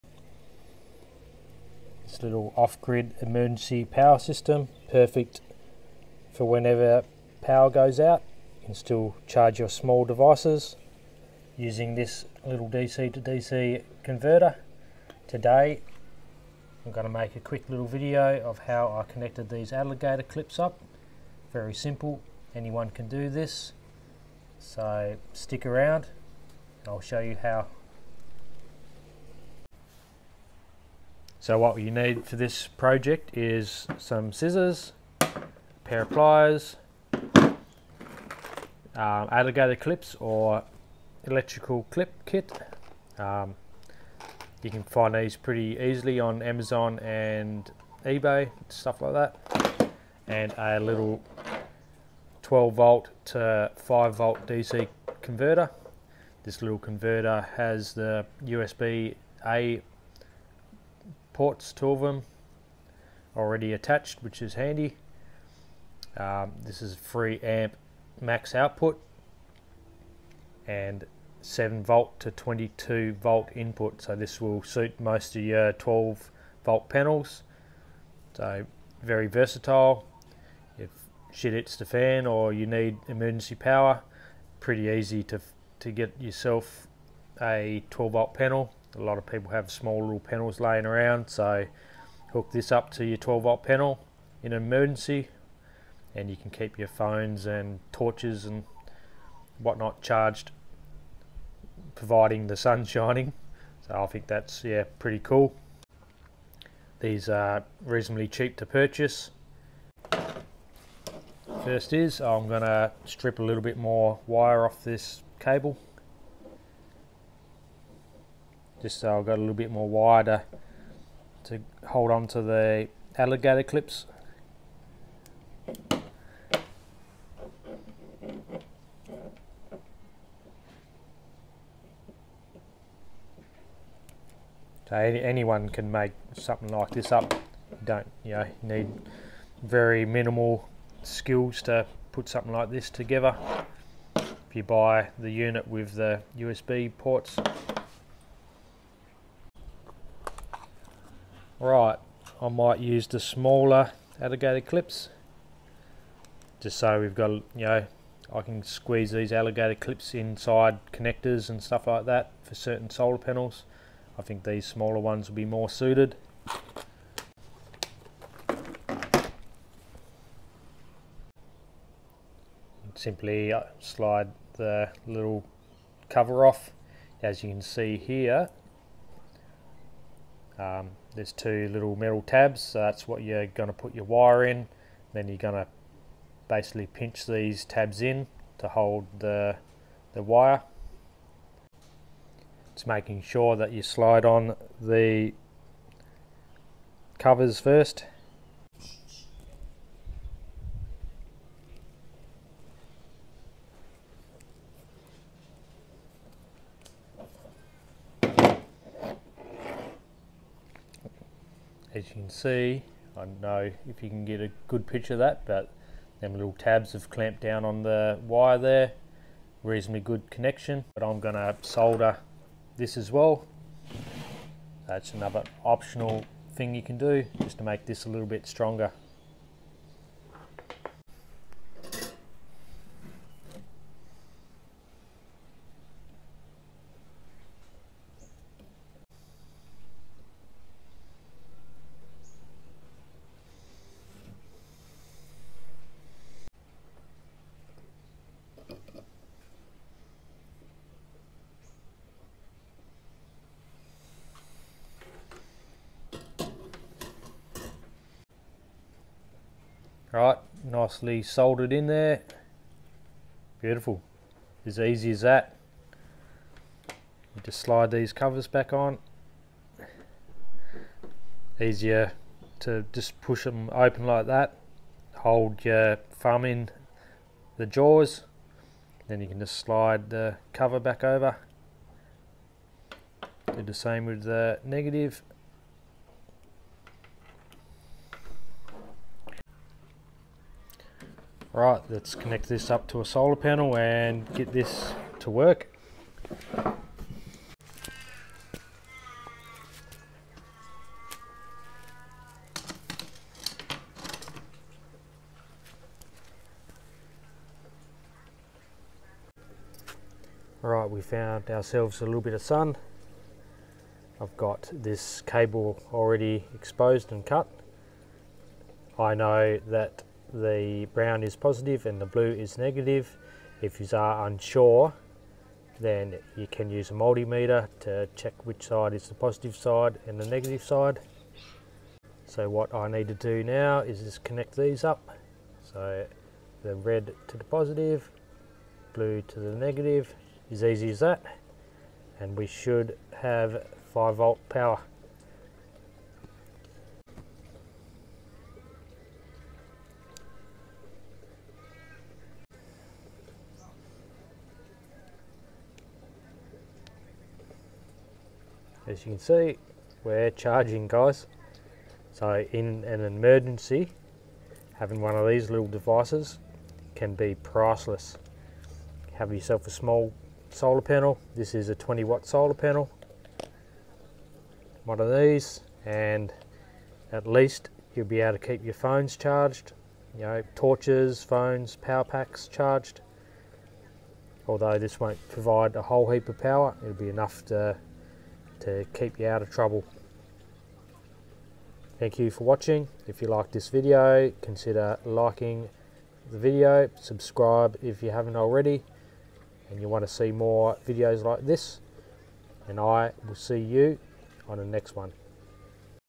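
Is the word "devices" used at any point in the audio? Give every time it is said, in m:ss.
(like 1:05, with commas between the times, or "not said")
0:10, 6:05.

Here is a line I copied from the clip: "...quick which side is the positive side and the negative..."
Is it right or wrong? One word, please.
wrong.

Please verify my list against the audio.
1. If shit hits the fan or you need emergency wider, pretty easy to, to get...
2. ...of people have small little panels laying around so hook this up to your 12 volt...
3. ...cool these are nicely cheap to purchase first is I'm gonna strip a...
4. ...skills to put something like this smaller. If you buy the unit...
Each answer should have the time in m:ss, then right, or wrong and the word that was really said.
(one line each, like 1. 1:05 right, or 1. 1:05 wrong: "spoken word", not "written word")
1. 1:20 wrong: "power", not "wider"
2. 1:29 right
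3. 1:45 wrong: "reasonably", not "nicely"
4. 2:21 wrong: "together", not "smaller".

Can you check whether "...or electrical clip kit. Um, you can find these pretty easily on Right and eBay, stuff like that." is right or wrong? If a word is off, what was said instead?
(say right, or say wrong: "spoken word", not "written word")
wrong: "Amazon", not "Right".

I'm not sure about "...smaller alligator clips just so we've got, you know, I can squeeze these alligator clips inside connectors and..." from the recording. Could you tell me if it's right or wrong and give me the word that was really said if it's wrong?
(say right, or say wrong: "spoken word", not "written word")
right.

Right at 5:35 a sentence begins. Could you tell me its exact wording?
So the red to the positive, blue to the negative, as easy as that.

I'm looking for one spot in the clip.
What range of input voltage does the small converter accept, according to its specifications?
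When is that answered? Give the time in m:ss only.
1:11.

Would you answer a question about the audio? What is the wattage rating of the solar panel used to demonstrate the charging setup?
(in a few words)
20 watts.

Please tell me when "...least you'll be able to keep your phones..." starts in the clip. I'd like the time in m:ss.
6:17.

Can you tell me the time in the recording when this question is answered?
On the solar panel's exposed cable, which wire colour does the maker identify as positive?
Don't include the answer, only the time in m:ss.
5:20.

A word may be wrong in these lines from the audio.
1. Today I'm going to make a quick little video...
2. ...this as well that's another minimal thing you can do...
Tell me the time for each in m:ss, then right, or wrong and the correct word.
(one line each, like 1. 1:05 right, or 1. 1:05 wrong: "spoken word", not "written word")
1. 0:15 right
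2. 3:42 wrong: "optional", not "minimal".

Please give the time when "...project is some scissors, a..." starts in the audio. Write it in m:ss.
0:32.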